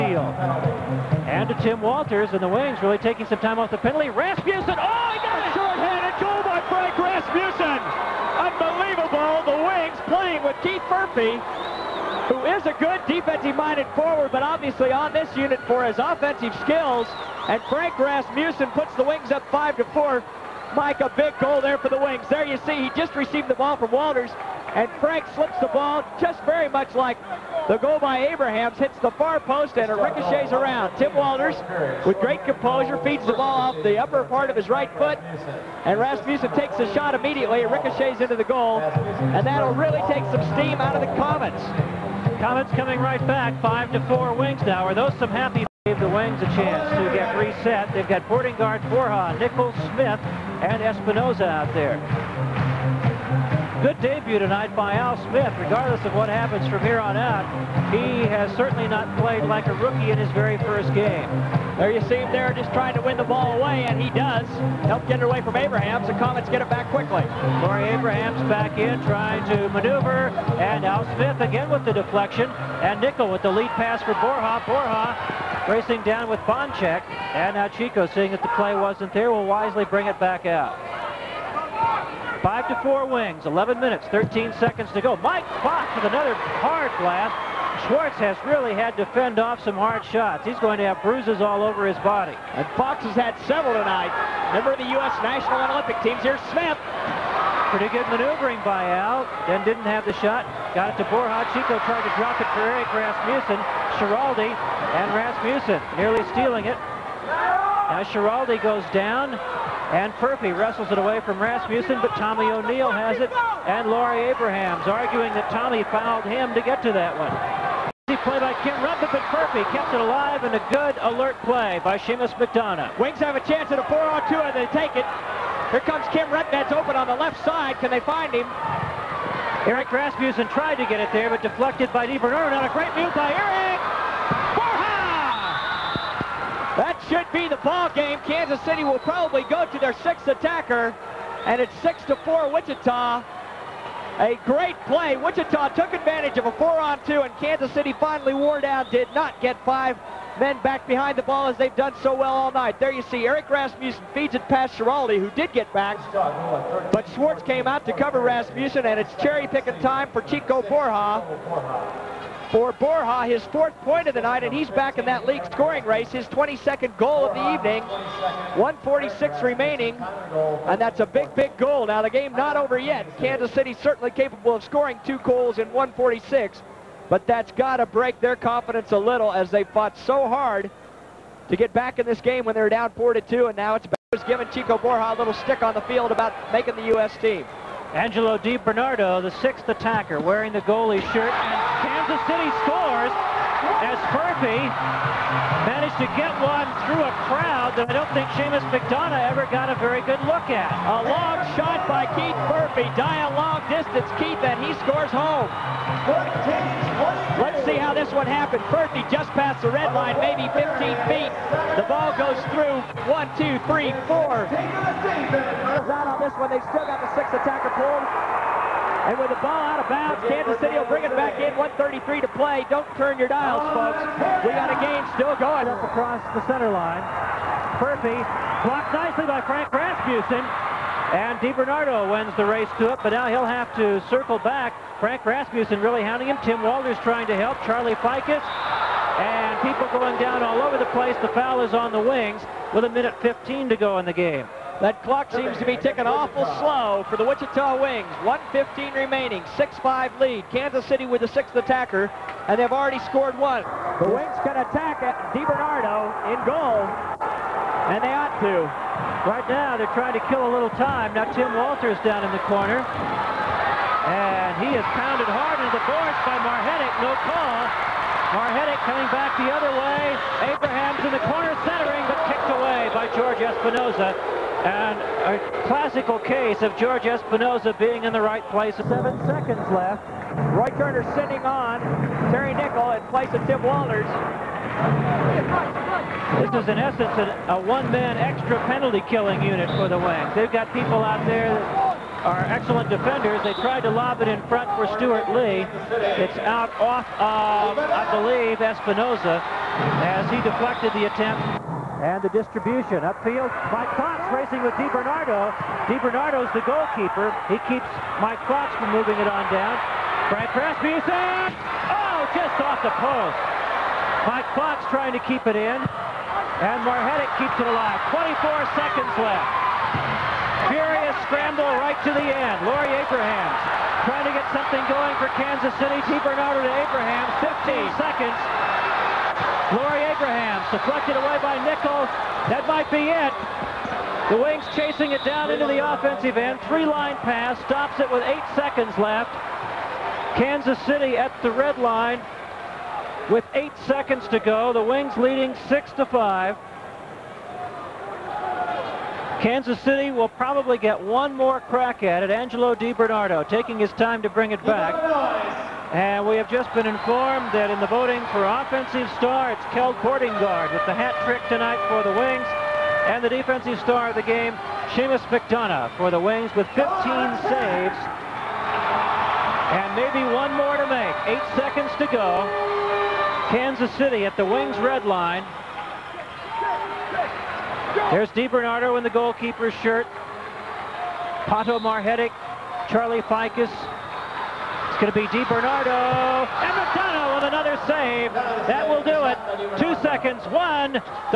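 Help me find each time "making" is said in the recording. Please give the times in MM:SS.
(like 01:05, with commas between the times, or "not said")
03:06.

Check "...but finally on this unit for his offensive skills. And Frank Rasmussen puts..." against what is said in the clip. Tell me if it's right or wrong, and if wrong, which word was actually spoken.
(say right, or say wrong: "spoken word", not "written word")
wrong: "obviously", not "finally".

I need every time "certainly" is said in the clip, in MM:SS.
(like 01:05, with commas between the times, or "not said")
00:58, 02:53.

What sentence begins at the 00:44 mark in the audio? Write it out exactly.
Are those some happy gave the Wings a chance to get reset.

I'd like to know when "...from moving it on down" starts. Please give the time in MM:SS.
05:08.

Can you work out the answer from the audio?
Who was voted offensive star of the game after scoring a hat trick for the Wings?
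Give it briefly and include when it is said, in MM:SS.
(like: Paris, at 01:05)
Keld Bordinggaard, at 05:59.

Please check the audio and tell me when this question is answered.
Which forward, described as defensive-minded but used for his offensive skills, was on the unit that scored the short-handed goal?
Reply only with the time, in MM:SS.
00:10.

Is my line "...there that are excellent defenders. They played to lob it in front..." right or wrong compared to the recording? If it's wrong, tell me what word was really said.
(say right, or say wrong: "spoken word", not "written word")
wrong: "tried", not "played".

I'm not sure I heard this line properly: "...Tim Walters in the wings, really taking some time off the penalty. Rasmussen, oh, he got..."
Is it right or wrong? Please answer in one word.
right.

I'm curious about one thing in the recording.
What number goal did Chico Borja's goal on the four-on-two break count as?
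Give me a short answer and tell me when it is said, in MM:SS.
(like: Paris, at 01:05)
22nd, at 02:46.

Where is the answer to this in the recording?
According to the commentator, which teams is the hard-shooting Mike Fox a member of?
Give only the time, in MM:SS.
01:34.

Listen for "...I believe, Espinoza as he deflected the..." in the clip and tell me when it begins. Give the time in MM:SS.
04:57.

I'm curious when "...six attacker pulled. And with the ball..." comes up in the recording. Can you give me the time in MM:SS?
03:37.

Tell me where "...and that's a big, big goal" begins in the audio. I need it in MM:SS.
02:50.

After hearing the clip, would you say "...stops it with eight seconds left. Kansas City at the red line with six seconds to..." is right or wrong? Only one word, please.
wrong.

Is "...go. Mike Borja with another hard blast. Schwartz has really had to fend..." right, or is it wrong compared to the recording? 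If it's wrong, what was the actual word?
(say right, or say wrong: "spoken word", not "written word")
wrong: "Fox", not "Borja".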